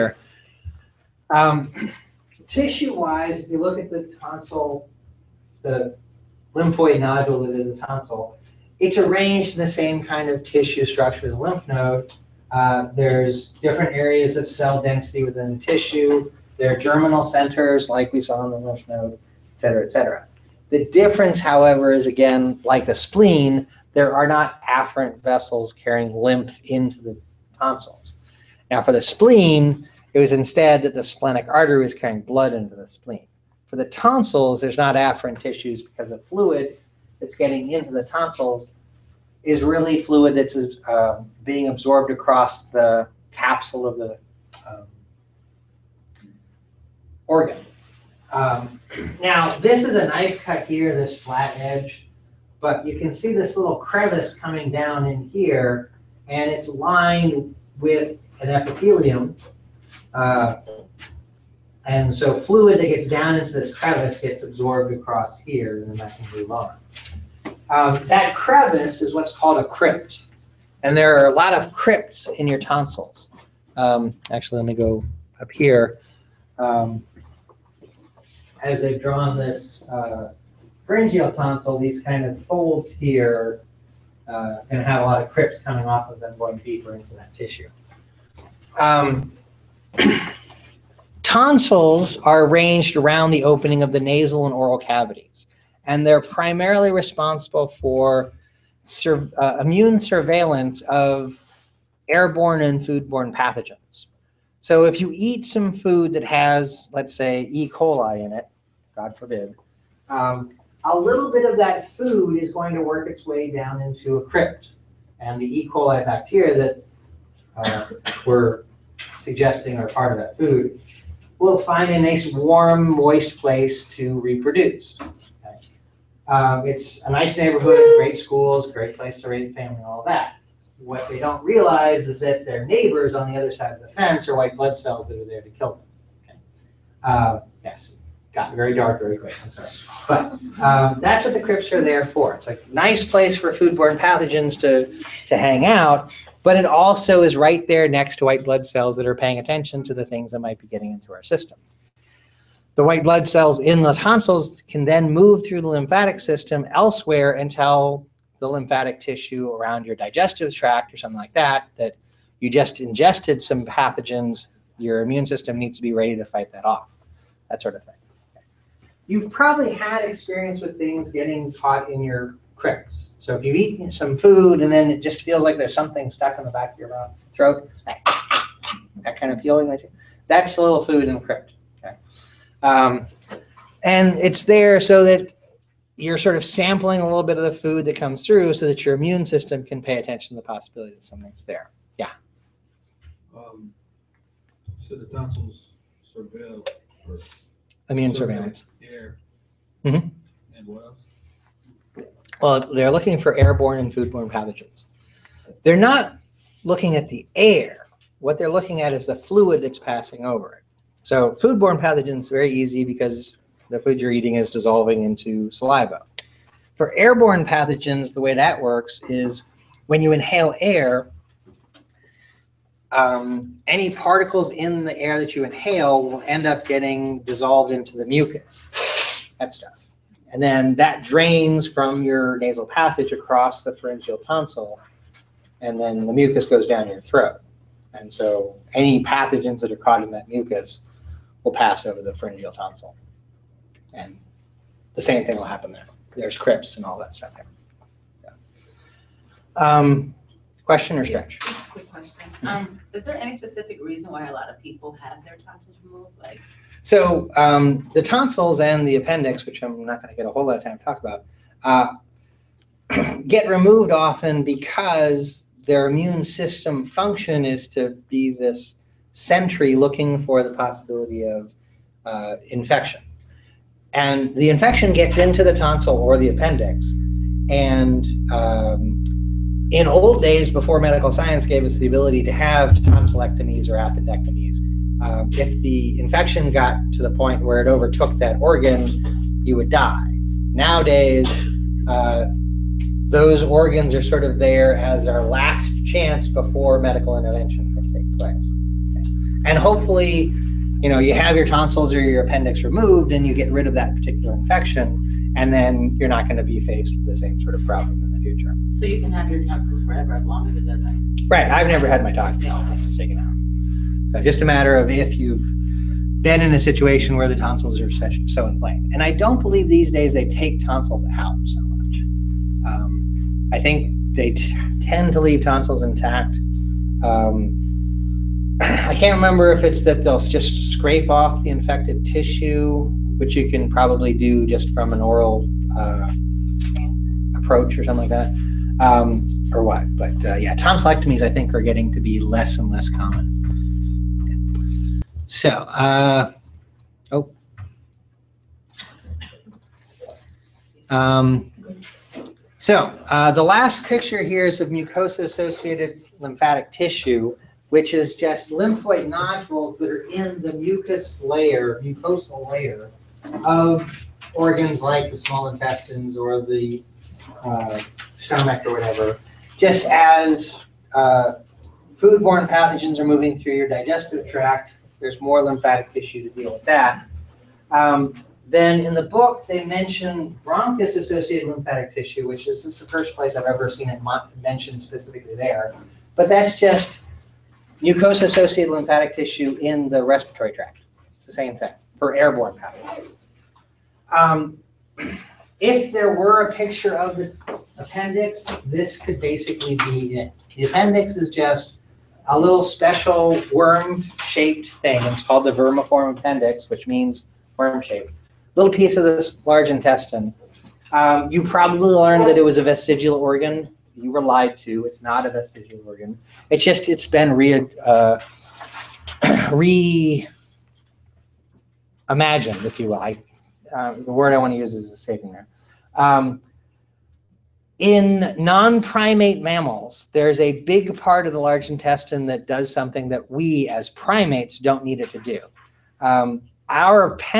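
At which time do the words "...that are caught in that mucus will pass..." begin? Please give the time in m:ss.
3:59.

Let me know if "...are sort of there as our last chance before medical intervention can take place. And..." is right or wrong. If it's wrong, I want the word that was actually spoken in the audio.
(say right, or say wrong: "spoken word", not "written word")
right.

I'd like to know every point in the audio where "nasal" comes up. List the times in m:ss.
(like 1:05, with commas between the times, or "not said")
1:34, 3:52.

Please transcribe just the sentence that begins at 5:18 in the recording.
And I don't believe these days they take tonsils out so much.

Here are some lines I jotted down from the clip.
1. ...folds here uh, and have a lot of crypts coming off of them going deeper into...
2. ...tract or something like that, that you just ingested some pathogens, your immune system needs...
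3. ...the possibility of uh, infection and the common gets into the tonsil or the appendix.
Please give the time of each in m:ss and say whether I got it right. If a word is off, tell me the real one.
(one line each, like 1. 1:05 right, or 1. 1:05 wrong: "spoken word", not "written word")
1. 1:22 right
2. 2:40 right
3. 4:30 wrong: "infection", not "common".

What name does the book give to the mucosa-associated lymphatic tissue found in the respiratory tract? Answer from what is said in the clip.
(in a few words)
bronchus associated lymphatic tissue.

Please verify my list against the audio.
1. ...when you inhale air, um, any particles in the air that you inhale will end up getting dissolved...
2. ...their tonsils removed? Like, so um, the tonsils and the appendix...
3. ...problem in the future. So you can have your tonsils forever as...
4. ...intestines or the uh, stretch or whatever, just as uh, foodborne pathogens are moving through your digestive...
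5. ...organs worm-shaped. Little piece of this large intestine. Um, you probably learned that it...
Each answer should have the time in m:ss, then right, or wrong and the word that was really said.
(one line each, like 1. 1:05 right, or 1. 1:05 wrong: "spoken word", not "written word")
1. 3:39 right
2. 4:15 right
3. 5:07 right
4. 6:05 wrong: "stomach", not "stretch"
5. 6:46 wrong: "means", not "organs".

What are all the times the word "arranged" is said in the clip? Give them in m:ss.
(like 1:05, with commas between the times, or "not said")
0:08, 1:32.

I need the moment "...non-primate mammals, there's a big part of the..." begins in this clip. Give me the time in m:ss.
7:08.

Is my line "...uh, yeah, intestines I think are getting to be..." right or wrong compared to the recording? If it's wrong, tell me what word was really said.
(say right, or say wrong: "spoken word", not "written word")
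wrong: "tonsillectomies", not "intestines".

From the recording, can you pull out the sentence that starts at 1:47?
coli in it, God forbid, um, a little bit of that food is going to work its way down into a crypt.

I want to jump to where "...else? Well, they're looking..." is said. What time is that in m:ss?
3:20.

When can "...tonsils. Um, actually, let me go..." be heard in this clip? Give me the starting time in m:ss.
1:12.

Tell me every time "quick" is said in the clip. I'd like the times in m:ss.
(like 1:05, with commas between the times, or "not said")
2:19, 4:11.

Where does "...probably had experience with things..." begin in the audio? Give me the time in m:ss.
2:49.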